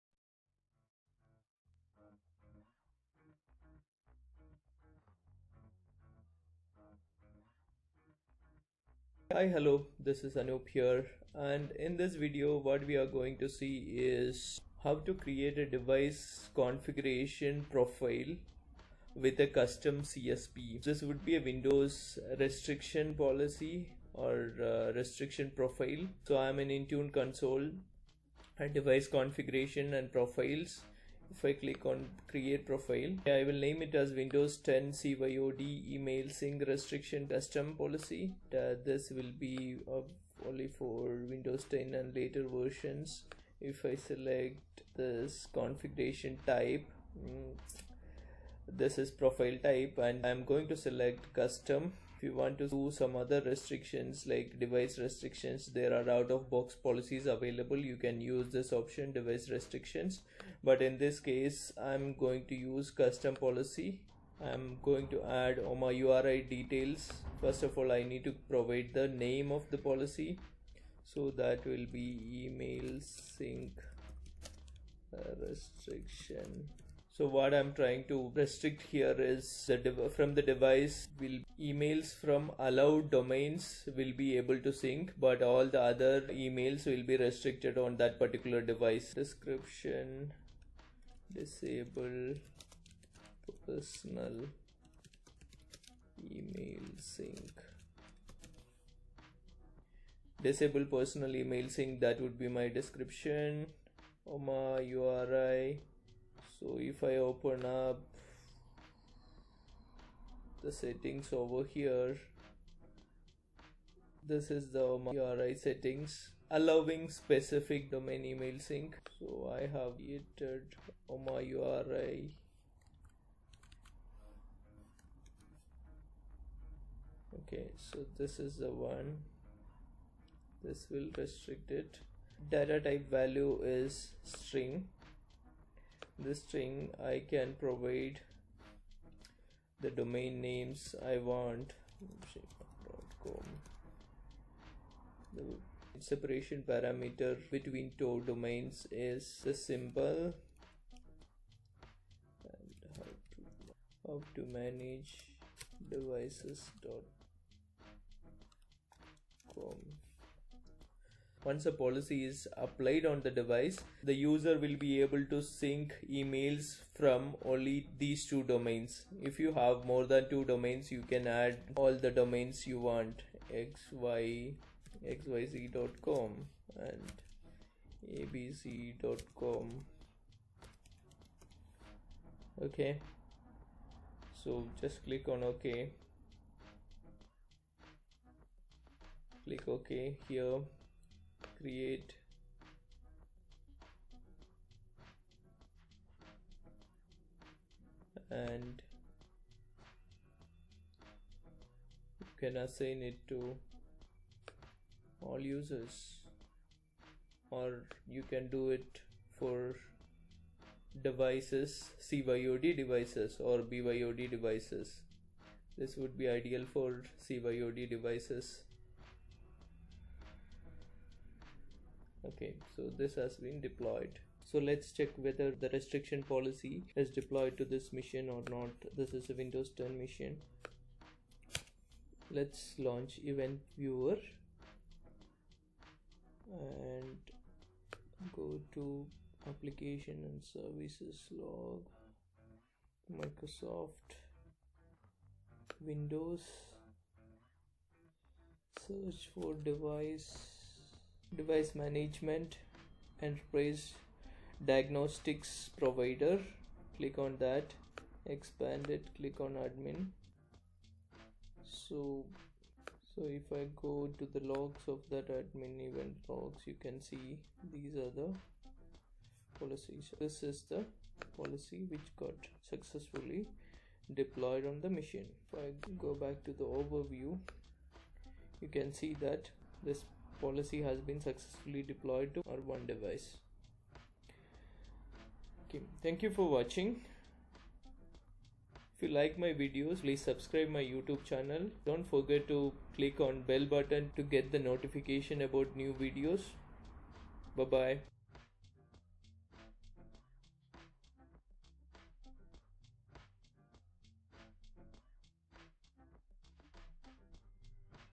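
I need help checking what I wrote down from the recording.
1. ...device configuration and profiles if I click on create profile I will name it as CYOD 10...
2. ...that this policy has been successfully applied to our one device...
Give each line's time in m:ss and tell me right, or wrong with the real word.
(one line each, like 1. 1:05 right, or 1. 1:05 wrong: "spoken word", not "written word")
1. 0:28 wrong: "Windows", not "CYOD"
2. 4:39 wrong: "deployed", not "applied".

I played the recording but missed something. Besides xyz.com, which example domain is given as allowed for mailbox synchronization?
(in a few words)
abc.com.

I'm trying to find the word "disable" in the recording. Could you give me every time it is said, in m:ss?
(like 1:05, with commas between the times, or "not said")
1:31, 1:40.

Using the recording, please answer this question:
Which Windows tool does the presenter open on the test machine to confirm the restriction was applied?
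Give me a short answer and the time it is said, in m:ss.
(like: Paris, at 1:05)
Event Viewer, at 3:53.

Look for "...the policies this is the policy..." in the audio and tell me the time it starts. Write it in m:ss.
4:28.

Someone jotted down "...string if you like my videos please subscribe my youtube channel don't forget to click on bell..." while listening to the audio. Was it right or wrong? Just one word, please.
wrong.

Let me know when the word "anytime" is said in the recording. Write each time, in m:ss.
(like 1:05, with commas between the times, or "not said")
not said.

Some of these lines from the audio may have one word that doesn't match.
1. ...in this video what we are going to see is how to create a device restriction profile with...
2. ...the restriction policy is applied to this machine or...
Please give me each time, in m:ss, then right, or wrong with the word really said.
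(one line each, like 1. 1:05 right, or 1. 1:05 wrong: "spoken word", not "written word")
1. 0:11 wrong: "configuration", not "restriction"
2. 3:45 wrong: "deployed", not "applied".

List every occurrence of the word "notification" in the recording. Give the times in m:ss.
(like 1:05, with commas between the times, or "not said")
4:54.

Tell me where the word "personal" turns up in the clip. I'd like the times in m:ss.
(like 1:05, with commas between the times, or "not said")
1:33, 1:40.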